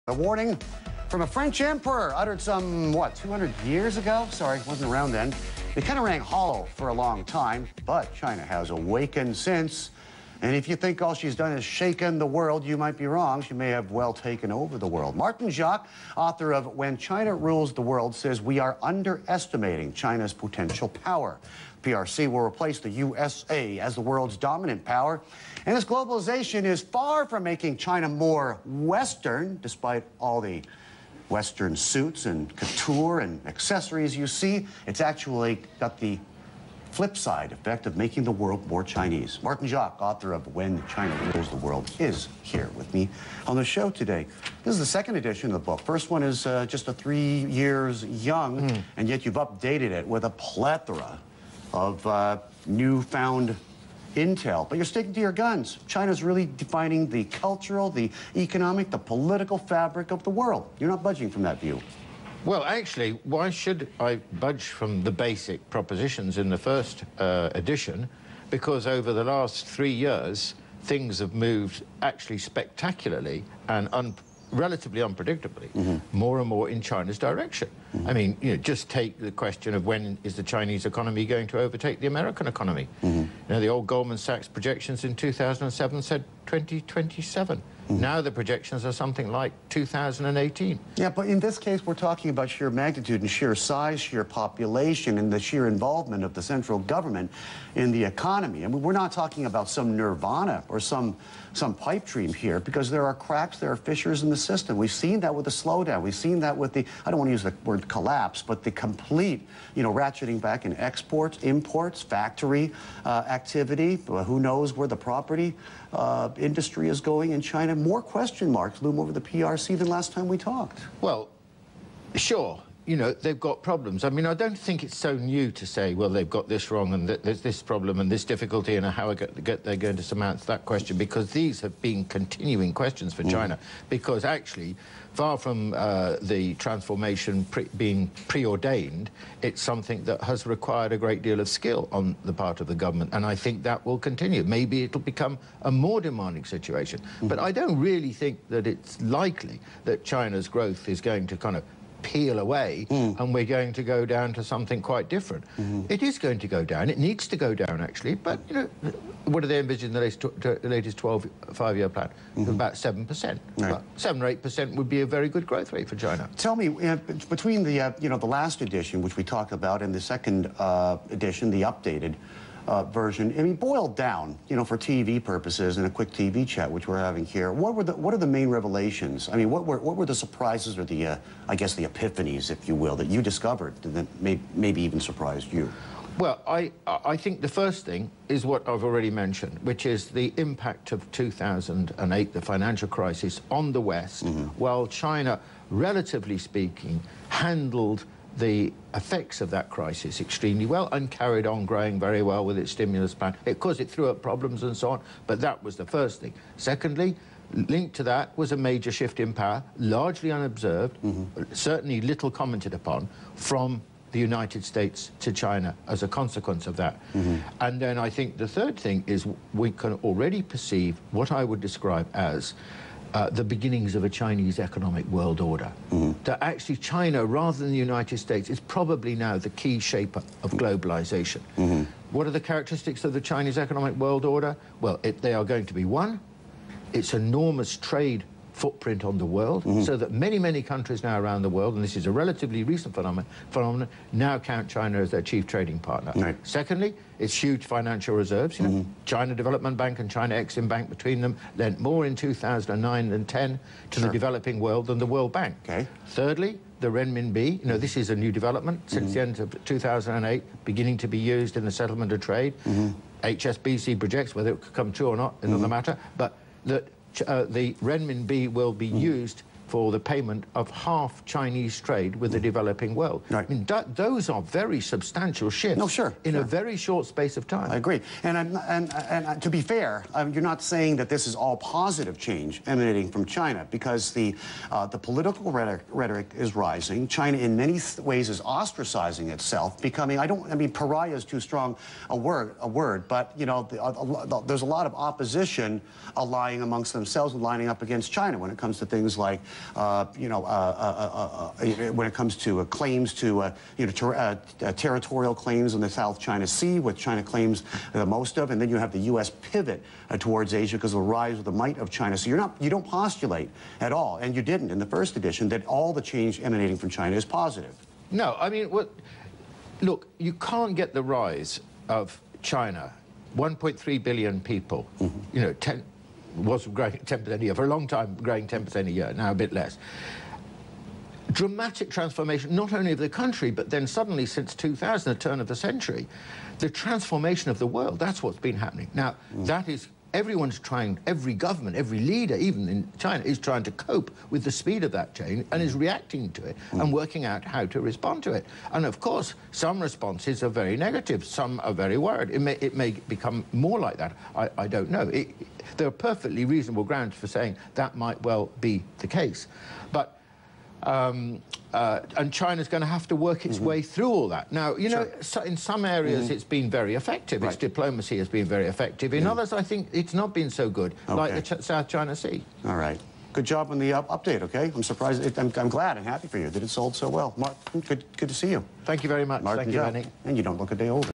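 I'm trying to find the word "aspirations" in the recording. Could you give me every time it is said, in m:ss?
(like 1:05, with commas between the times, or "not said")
not said.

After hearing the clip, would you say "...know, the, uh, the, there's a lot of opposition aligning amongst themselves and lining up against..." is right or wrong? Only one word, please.
right.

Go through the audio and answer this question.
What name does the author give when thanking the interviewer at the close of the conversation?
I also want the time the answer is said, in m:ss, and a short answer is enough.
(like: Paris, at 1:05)
Manny, at 6:19.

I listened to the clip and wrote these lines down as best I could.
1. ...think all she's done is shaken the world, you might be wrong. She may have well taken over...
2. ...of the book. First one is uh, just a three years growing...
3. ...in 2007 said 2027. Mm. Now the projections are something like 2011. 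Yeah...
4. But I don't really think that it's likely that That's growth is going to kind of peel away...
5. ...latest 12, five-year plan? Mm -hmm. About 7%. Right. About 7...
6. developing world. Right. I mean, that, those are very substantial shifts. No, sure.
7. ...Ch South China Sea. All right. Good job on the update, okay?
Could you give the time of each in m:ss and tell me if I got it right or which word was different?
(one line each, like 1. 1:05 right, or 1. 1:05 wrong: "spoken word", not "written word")
1. 0:10 right
2. 0:45 wrong: "young", not "growing"
3. 1:25 wrong: "2018", not "2011"
4. 2:27 wrong: "China", not "That"
5. 2:40 right
6. 4:32 right
7. 6:11 right.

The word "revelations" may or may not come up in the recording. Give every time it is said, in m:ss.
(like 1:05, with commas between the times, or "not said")
2:58.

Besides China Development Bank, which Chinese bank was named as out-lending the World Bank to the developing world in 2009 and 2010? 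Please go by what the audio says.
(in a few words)
China Exim Bank.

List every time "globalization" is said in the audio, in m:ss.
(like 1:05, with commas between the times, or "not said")
0:25, 3:50.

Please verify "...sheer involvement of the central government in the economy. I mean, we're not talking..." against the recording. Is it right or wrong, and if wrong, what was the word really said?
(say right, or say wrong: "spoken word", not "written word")
right.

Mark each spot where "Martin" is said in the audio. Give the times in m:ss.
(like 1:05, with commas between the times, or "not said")
0:15, 0:39, 6:19.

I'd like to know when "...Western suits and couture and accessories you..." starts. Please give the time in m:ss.
0:31.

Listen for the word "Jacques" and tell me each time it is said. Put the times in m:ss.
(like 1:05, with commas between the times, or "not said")
0:15, 0:39.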